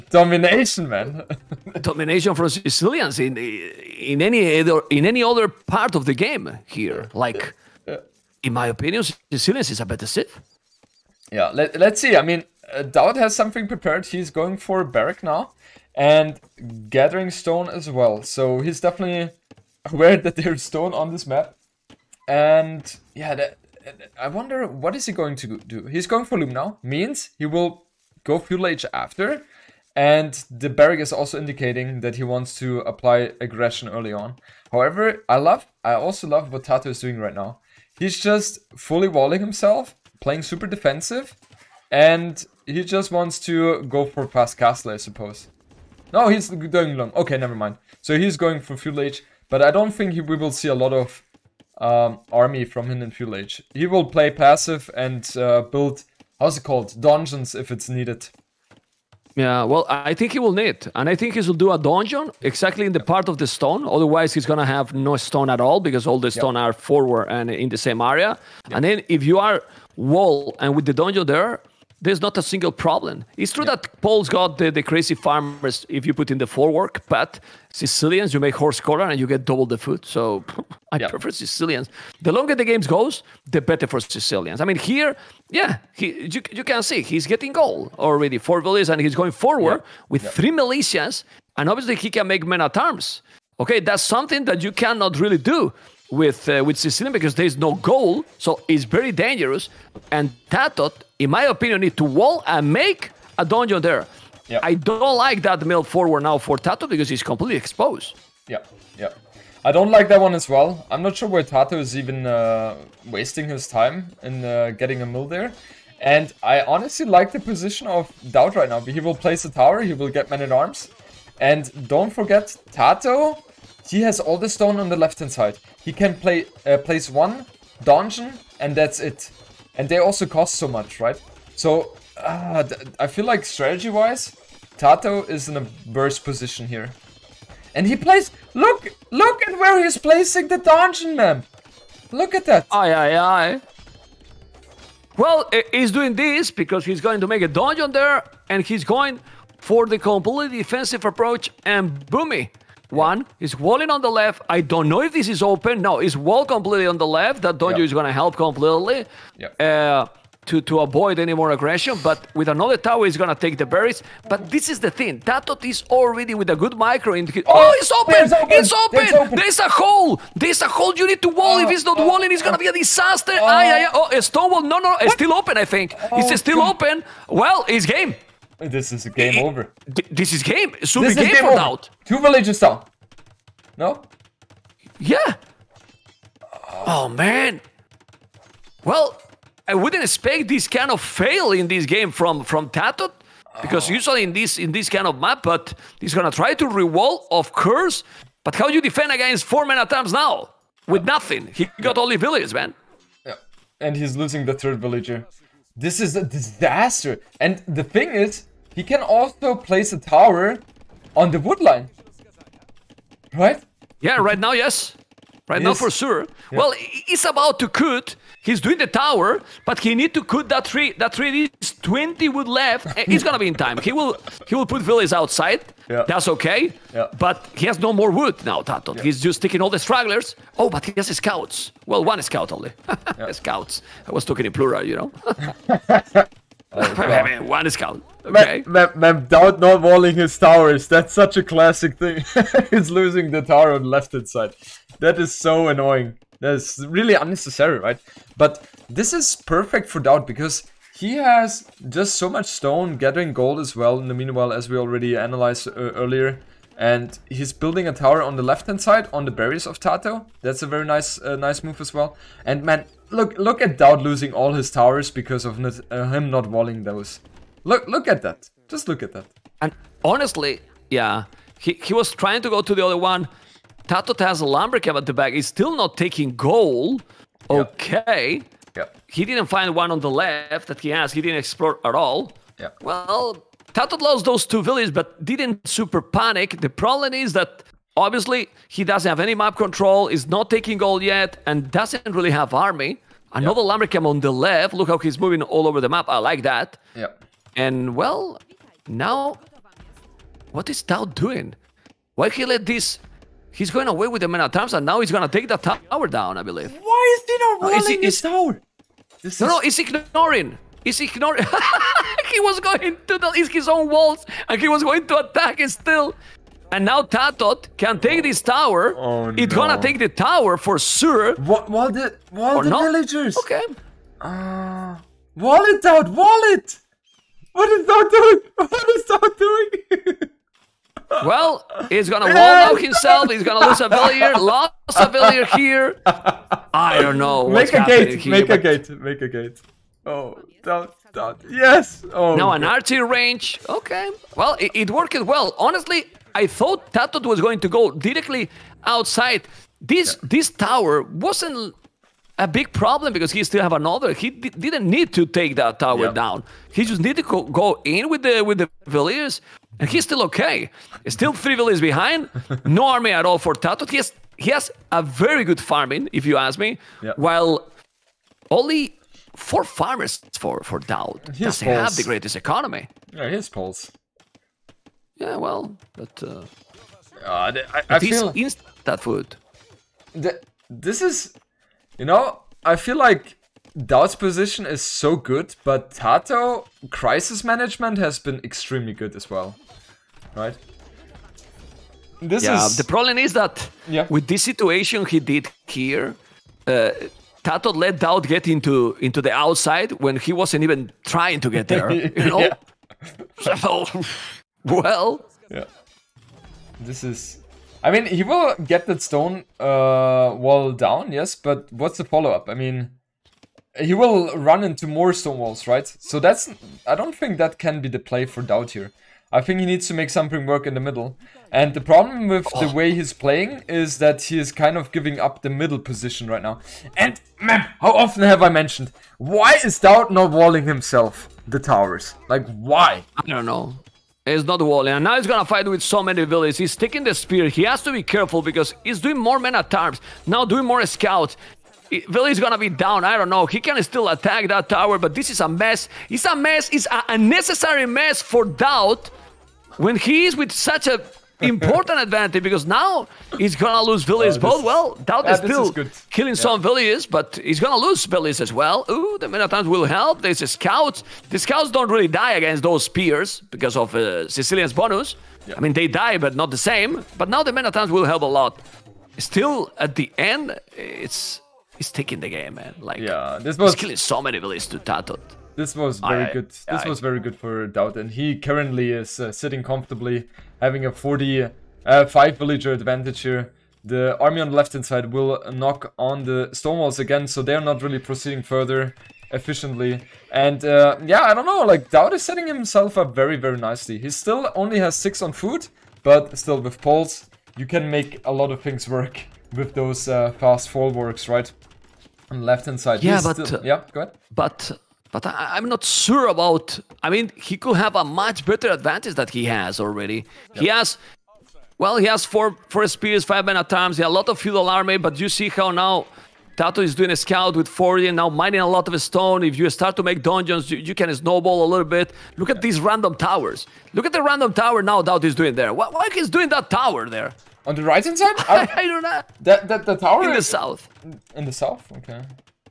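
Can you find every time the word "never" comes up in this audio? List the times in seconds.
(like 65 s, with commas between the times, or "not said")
47 s.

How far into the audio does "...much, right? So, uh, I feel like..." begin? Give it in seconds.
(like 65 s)
130 s.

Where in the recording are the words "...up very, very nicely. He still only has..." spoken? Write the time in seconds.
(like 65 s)
492 s.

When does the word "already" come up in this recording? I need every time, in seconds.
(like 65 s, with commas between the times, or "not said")
87 s, 165 s, 254 s, 509 s.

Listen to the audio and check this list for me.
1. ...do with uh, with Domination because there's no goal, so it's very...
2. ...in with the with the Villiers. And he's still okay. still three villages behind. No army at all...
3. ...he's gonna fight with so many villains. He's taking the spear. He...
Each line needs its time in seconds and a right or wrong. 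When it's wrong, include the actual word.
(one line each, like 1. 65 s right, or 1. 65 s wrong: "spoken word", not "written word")
1. 95 s wrong: "Sicilian", not "Domination"
2. 357 s right
3. 435 s right.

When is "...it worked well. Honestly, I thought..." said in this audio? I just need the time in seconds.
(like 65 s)
344 s.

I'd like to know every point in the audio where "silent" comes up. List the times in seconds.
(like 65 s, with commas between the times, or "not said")
not said.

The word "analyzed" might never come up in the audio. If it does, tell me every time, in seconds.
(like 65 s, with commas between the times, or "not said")
255 s.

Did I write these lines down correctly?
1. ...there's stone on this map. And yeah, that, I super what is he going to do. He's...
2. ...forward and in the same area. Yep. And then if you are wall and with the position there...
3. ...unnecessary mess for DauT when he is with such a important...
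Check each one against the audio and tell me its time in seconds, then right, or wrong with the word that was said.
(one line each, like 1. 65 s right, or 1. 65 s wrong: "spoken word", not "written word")
1. 20 s wrong: "wonder", not "super"
2. 66 s wrong: "donjon", not "position"
3. 447 s right.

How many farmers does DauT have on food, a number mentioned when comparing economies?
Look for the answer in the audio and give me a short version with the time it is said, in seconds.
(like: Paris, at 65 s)
4, at 369 s.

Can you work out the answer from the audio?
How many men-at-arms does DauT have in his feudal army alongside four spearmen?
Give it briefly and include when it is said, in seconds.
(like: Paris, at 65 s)
5, at 513 s.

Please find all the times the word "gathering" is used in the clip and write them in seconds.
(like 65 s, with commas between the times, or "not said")
16 s, 252 s.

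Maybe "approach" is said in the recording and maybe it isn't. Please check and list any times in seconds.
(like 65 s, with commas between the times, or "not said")
151 s.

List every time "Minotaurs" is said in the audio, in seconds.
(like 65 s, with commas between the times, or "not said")
459 s, 467 s.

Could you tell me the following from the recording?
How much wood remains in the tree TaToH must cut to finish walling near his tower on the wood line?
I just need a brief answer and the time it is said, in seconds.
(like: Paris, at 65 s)
20, at 221 s.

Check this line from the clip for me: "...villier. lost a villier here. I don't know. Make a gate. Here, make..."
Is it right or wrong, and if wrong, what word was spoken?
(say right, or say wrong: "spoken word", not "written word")
right.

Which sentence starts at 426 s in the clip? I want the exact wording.
And, man, how often have I mentioned, why is DauT not walling himself the towers?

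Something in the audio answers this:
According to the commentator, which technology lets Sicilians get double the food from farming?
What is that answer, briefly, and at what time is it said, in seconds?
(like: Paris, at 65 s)
Horse collar, at 78 s.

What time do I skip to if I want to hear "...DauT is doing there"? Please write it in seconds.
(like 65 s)
525 s.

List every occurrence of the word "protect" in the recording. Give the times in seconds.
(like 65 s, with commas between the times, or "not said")
not said.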